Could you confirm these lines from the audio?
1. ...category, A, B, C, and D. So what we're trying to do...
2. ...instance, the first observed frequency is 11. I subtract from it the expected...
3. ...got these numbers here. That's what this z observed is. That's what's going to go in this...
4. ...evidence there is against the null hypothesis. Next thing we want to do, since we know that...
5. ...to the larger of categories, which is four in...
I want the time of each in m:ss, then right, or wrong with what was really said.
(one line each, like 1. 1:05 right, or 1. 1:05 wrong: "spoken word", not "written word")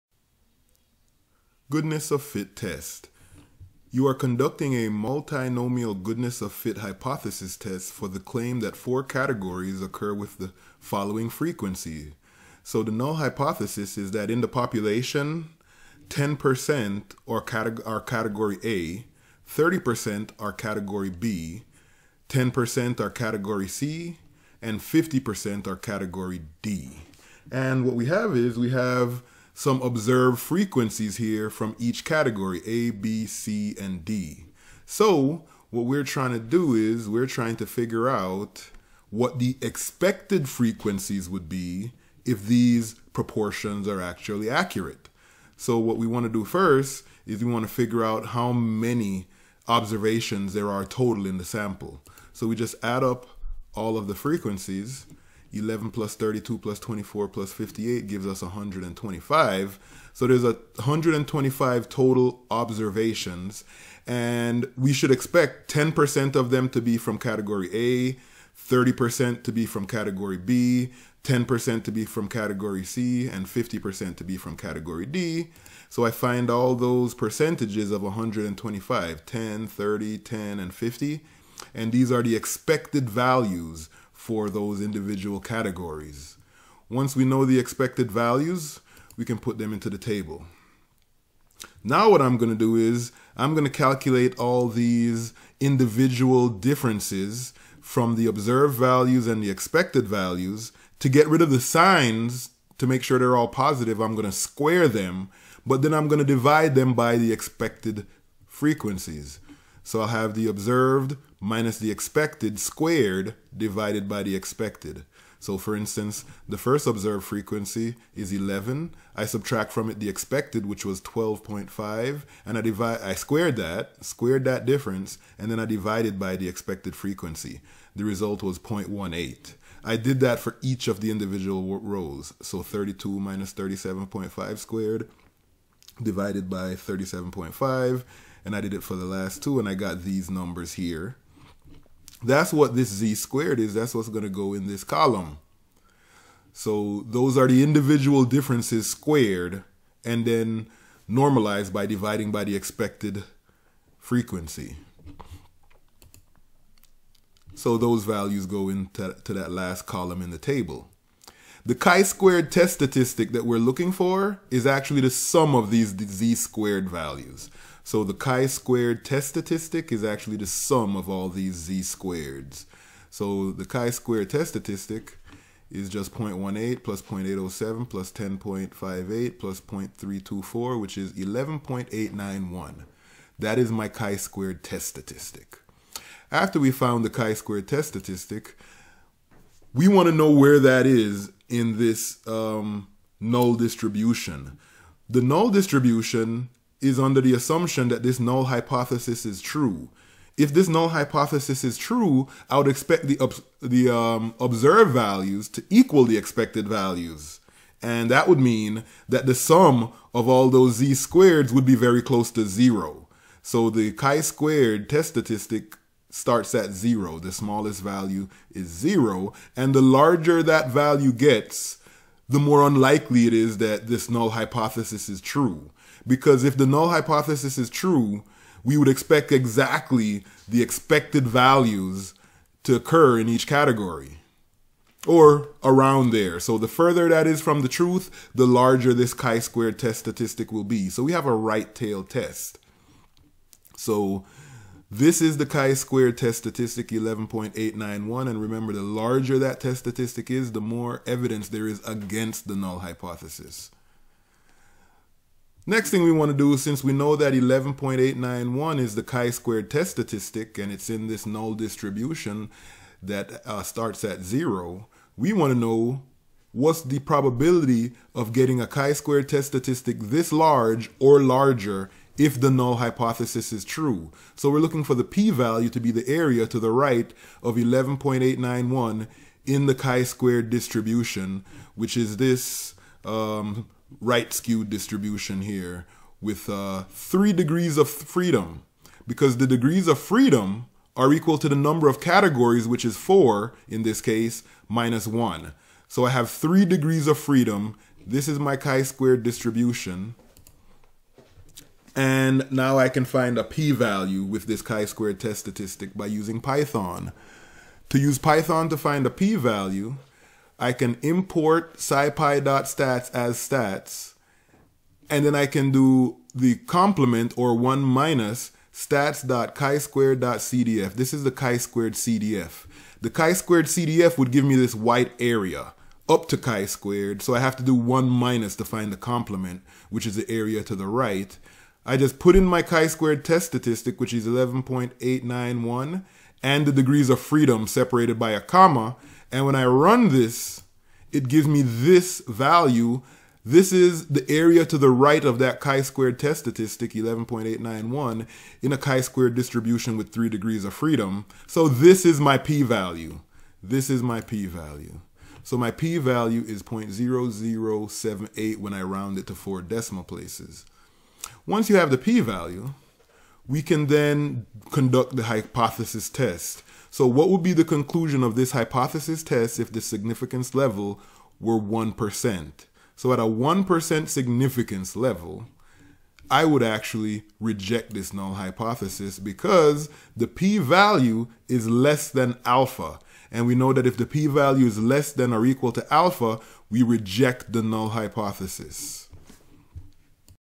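1. 0:32 right
2. 1:55 right
3. 2:19 wrong: "squared", not "observed"
4. 4:11 right
5. 4:51 wrong: "number", not "larger".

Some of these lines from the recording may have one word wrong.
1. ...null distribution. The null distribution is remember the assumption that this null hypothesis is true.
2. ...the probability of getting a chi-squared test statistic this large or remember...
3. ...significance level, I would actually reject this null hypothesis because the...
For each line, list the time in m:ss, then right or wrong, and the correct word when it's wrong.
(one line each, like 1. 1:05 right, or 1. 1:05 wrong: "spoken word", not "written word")
1. 3:13 wrong: "under", not "remember"
2. 4:26 wrong: "larger", not "remember"
3. 6:14 right.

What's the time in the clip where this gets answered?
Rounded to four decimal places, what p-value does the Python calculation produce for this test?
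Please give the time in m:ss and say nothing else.
5:56.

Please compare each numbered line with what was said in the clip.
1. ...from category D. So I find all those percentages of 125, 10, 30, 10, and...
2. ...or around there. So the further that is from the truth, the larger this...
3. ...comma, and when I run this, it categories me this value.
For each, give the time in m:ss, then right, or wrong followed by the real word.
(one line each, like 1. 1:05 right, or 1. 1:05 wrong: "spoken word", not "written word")
1. 1:14 right
2. 3:55 right
3. 5:38 wrong: "gives", not "categories".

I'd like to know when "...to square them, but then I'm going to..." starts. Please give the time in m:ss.
1:44.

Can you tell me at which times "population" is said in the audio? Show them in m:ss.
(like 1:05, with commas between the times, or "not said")
0:14.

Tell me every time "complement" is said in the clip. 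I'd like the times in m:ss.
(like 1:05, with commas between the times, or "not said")
5:16, 5:28.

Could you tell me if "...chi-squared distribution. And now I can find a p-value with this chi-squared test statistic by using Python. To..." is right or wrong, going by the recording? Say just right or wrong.
right.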